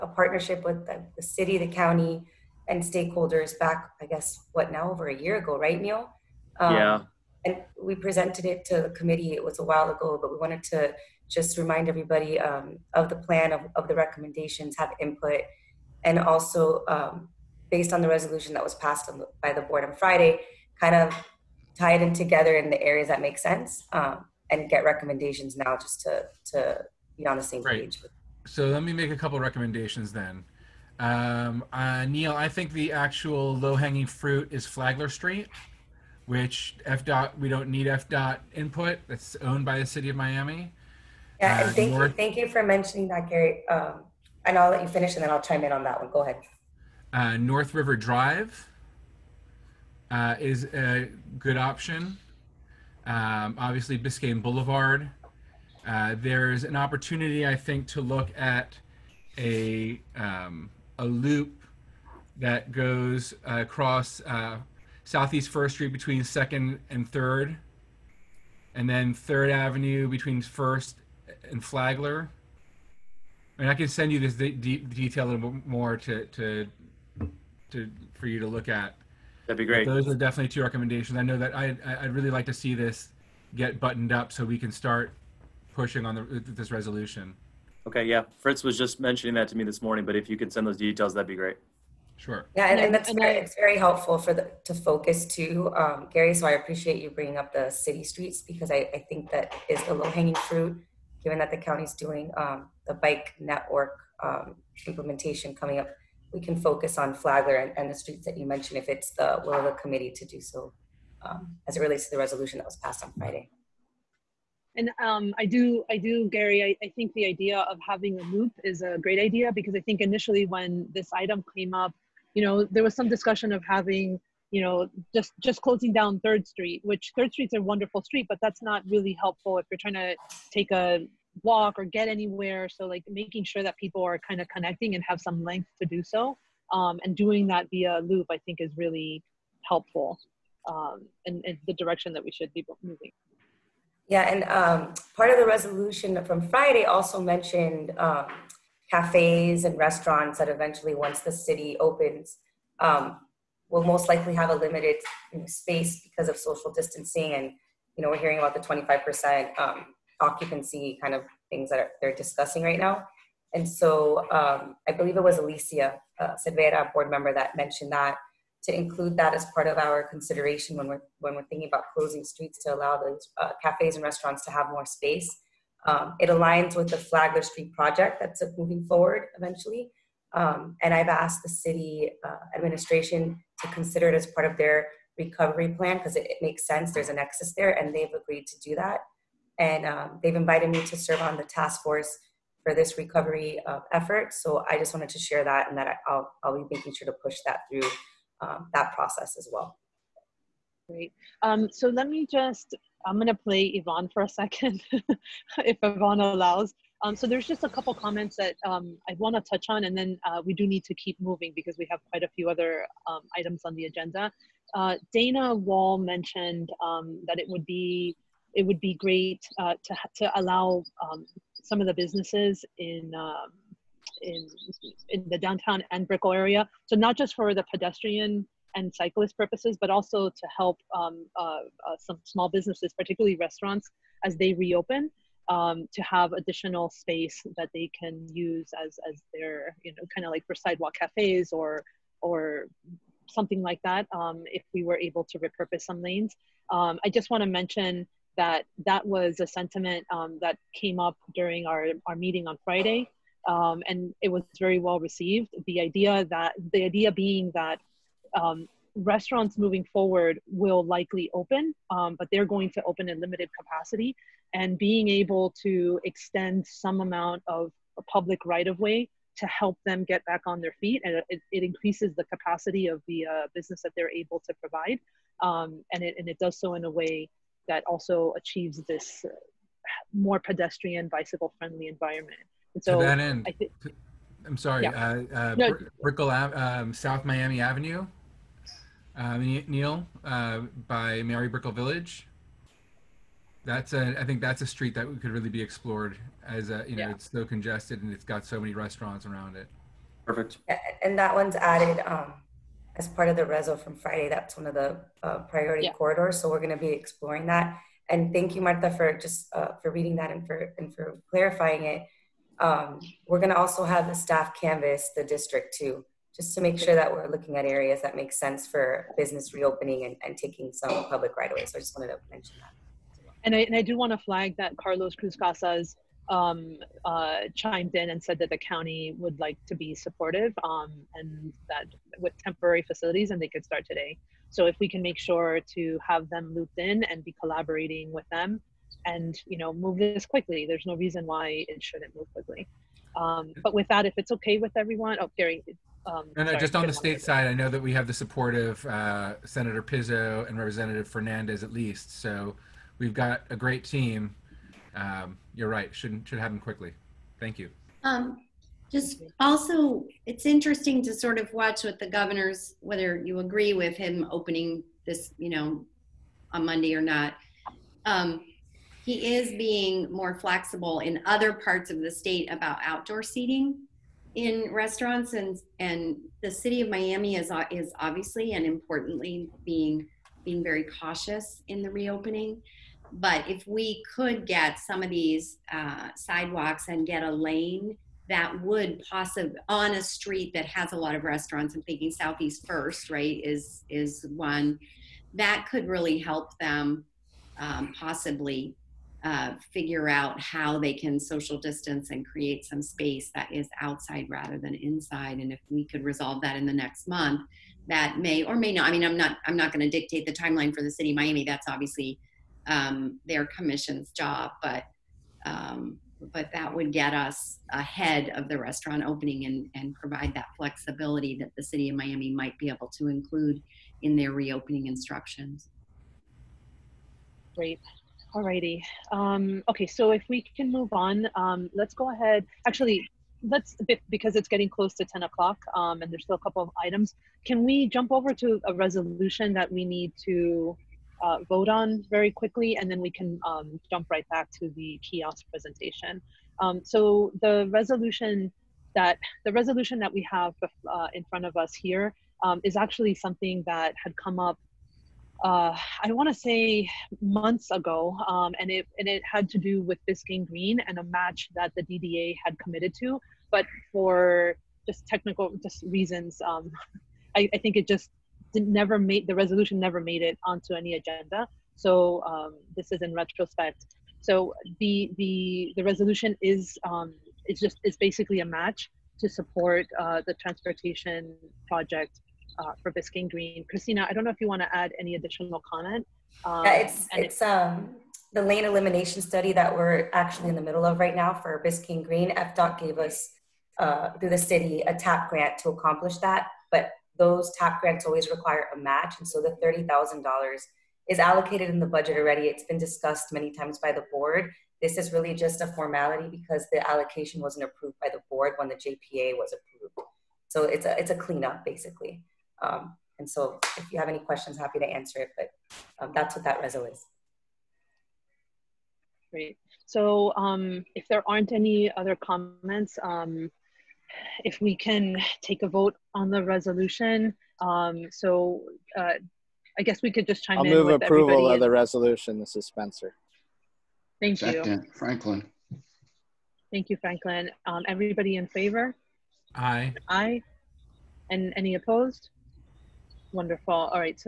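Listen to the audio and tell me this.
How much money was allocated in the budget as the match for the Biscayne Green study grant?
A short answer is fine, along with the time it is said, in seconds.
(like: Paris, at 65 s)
$30,000, at 499 s.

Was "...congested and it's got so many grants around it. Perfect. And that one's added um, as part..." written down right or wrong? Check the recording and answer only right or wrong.
wrong.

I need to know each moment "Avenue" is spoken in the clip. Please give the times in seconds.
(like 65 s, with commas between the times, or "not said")
69 s, 287 s.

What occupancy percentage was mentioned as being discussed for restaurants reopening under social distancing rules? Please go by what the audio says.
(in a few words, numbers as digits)
25%.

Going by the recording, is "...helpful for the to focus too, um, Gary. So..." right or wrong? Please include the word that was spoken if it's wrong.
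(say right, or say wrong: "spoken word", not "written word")
right.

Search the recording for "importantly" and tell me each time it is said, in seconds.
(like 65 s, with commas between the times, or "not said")
378 s.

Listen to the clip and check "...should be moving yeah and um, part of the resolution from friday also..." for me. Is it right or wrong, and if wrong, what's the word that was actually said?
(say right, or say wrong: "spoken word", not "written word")
right.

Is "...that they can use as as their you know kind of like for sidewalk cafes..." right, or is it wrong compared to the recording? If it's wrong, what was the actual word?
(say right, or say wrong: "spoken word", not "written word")
right.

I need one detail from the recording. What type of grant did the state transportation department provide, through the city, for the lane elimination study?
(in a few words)
TAP grant.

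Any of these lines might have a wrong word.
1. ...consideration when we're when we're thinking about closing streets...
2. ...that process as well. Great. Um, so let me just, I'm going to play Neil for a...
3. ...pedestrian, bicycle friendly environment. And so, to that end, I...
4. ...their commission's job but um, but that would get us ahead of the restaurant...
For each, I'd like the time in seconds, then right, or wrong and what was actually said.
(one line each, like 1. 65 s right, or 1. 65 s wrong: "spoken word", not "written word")
1. 170 s right
2. 198 s wrong: "Yvonne", not "Neil"
3. 280 s right
4. 413 s right.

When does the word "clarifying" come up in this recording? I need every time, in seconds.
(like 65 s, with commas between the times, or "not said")
311 s.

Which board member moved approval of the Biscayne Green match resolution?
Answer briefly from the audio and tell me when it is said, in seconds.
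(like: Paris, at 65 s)
Spencer, at 532 s.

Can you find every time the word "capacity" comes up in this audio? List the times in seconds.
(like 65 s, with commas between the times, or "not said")
263 s, 272 s.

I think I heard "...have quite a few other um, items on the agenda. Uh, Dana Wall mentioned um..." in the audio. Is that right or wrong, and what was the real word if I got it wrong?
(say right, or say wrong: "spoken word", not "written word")
right.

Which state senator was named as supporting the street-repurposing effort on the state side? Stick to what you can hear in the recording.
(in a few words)
Senator Pizzo.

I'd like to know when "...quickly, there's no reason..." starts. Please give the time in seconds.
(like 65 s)
340 s.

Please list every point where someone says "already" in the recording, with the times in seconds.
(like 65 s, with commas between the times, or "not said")
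502 s.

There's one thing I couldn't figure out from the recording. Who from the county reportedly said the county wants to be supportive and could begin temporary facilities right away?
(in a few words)
Carlos Cruz Casas.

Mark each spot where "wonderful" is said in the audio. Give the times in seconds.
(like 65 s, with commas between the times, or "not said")
127 s, 543 s.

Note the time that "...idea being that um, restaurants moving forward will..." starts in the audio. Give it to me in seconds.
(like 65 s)
256 s.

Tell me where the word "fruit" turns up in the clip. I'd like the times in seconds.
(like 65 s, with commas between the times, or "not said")
34 s, 100 s.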